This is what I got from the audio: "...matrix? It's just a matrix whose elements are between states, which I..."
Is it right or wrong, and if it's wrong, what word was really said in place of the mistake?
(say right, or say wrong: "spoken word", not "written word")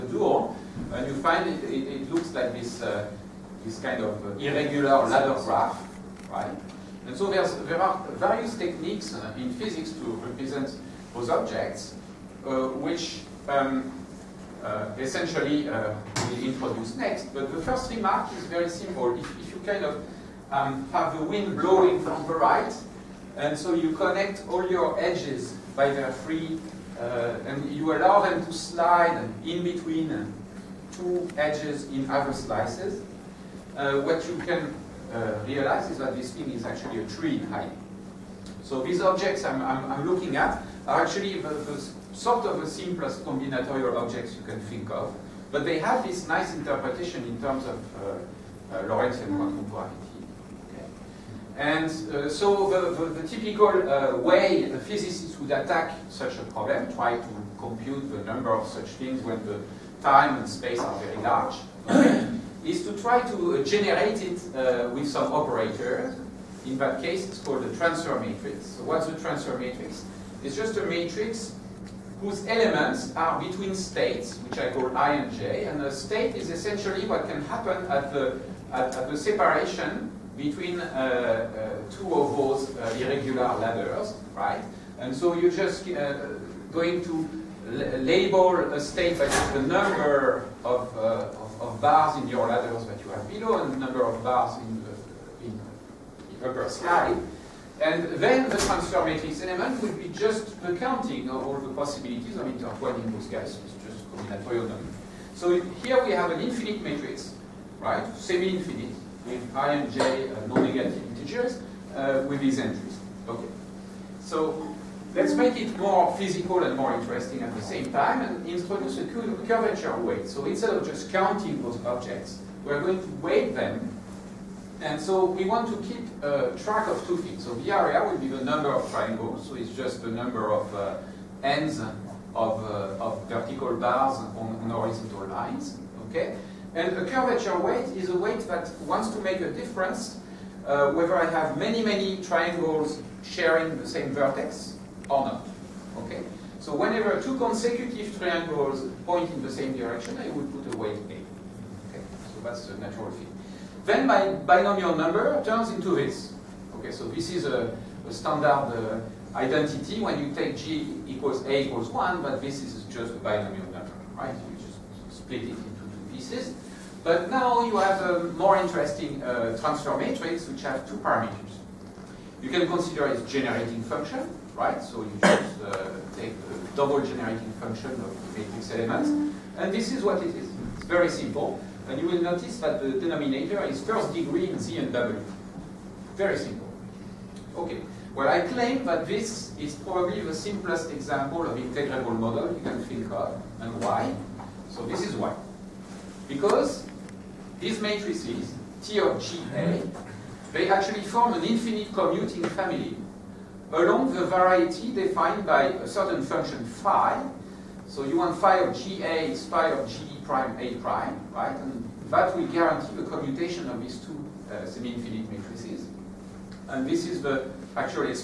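right.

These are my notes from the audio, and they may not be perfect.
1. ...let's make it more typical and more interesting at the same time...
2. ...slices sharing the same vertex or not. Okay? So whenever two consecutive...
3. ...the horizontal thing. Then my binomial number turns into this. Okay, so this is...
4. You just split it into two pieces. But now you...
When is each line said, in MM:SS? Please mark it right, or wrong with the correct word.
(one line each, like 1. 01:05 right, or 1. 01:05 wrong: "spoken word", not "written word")
1. 01:55 wrong: "physical", not "typical"
2. 02:22 wrong: "triangles", not "slices"
3. 02:32 wrong: "natural", not "horizontal"
4. 02:44 right.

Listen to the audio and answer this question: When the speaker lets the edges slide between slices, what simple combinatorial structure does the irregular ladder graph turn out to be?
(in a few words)
A tree.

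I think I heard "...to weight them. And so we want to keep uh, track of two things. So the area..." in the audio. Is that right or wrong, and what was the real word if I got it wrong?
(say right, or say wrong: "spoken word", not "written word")
right.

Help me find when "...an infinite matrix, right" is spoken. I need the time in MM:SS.
01:46.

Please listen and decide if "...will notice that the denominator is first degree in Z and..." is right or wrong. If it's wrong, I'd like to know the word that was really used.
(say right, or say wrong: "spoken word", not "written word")
right.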